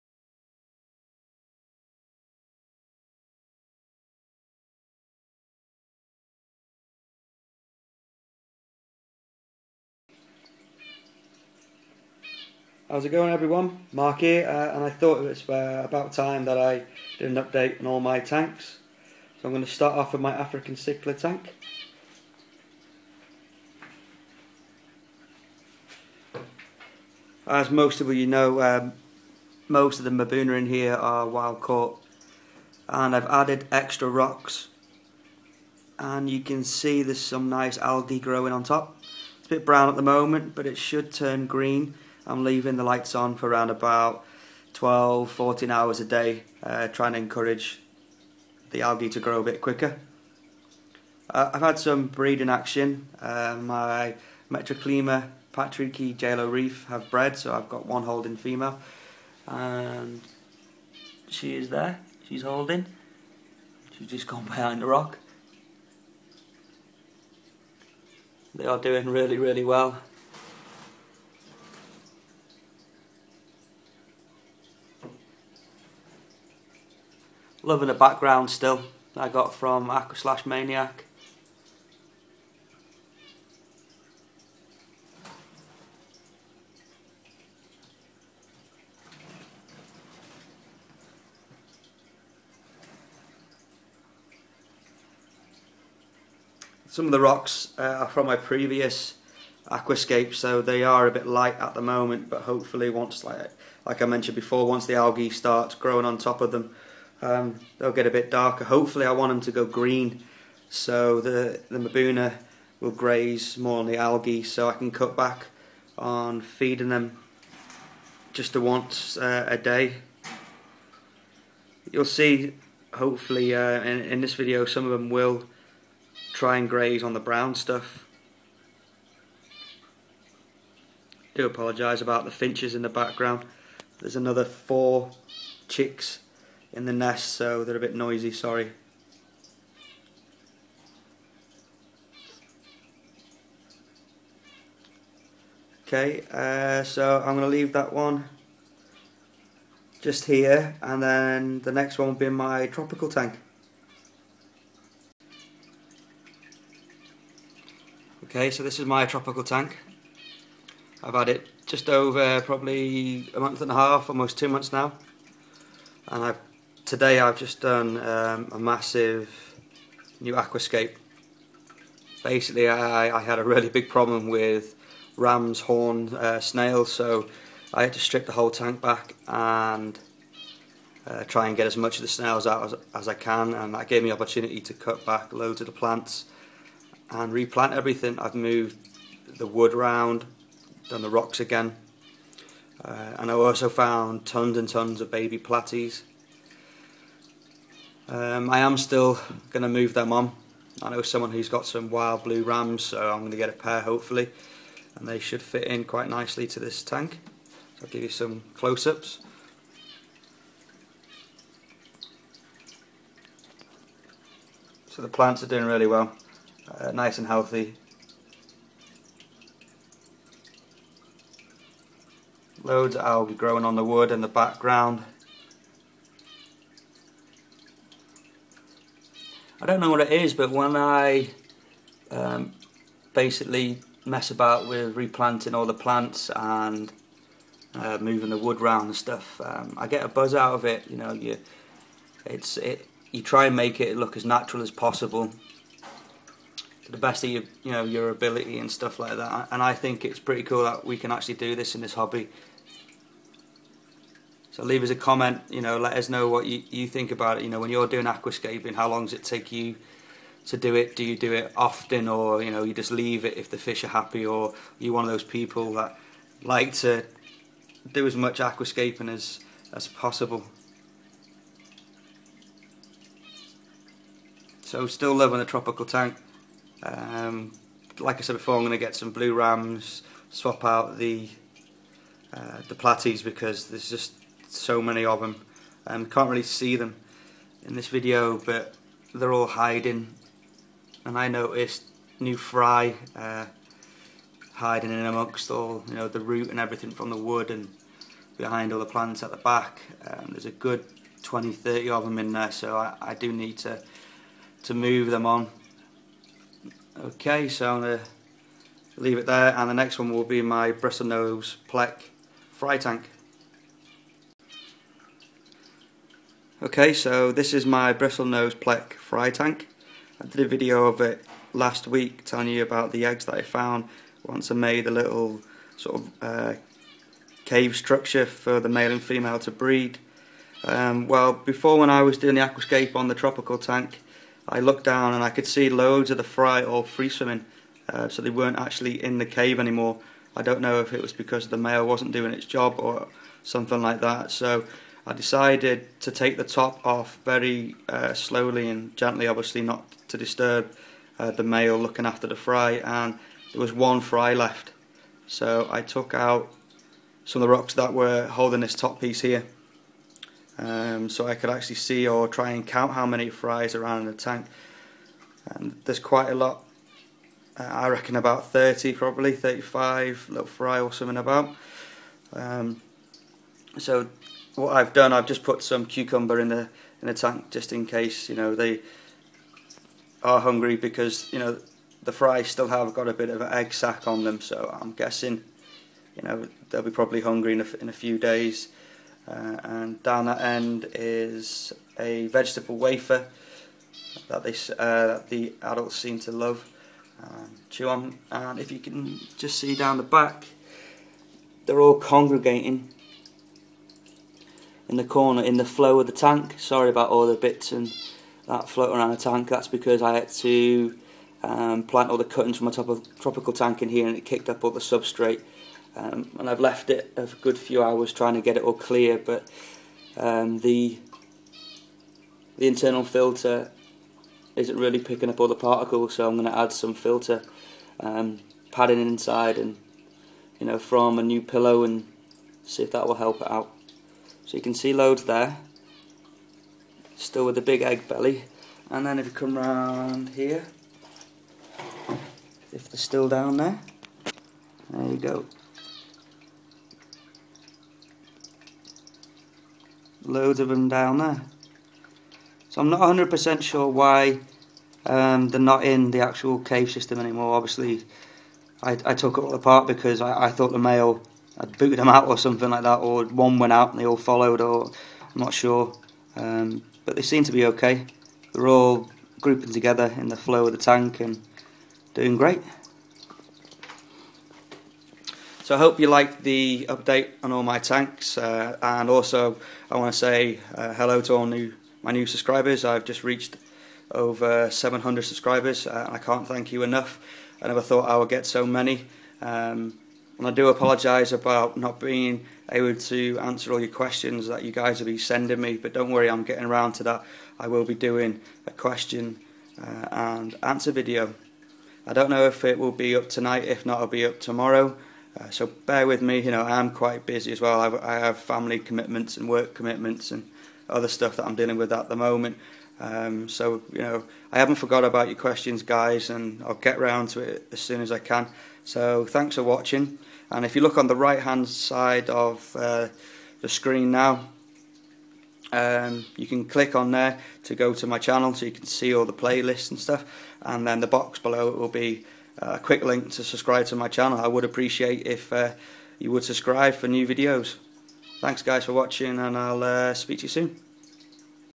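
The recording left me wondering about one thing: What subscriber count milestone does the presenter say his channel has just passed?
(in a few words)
700.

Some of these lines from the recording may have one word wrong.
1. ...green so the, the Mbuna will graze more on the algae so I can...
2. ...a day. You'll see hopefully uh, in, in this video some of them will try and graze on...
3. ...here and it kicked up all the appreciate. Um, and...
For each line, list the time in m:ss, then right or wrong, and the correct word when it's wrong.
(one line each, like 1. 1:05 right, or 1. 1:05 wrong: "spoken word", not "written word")
1. 1:49 right
2. 1:59 right
3. 6:53 wrong: "substrate", not "appreciate".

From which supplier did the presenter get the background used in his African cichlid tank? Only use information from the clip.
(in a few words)
Aqua Slash Maniac.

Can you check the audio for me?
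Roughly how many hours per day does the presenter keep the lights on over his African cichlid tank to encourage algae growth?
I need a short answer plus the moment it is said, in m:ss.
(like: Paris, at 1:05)
12-14 hours, at 0:44.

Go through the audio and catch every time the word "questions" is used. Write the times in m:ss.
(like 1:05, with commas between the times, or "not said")
8:13, 8:18, 8:35.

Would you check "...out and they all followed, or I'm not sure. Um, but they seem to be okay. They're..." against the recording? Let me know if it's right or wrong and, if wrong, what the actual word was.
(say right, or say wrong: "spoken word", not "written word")
right.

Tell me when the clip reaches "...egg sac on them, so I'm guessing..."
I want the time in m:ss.
6:23.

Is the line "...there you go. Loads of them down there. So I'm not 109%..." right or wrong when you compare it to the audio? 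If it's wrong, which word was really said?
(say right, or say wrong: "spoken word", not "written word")
wrong: "100", not "109".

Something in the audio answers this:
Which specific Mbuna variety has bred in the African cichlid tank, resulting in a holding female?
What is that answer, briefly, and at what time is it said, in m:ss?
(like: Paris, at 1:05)
Metriaclima Patricki jalo reef, at 0:54.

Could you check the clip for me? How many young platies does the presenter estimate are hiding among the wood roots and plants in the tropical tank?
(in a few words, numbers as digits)
20-30.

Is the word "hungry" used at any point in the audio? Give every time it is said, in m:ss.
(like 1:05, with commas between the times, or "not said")
6:20, 6:27.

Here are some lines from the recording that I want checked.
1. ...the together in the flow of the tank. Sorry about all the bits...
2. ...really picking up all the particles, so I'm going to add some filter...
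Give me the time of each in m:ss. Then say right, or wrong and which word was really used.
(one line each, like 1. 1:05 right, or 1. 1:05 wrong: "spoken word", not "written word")
1. 6:44 wrong: "corner", not "together"
2. 7:04 right.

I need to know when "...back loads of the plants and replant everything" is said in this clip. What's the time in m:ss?
3:05.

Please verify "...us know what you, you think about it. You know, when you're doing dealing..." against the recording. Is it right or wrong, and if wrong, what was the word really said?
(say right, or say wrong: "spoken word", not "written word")
wrong: "aquascaping", not "dealing".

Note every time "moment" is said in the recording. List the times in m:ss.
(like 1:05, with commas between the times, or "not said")
0:40, 1:41, 8:32.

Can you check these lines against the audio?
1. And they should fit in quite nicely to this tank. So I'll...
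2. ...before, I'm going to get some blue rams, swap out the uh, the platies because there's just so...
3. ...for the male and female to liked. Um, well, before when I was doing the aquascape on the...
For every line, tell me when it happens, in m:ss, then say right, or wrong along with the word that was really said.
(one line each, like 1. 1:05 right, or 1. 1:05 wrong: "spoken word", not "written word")
1. 3:24 right
2. 4:38 right
3. 5:28 wrong: "breed", not "liked".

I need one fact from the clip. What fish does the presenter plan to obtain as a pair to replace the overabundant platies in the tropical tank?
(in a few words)
Wild blue rams.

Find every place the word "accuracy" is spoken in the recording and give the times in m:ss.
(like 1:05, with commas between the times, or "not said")
not said.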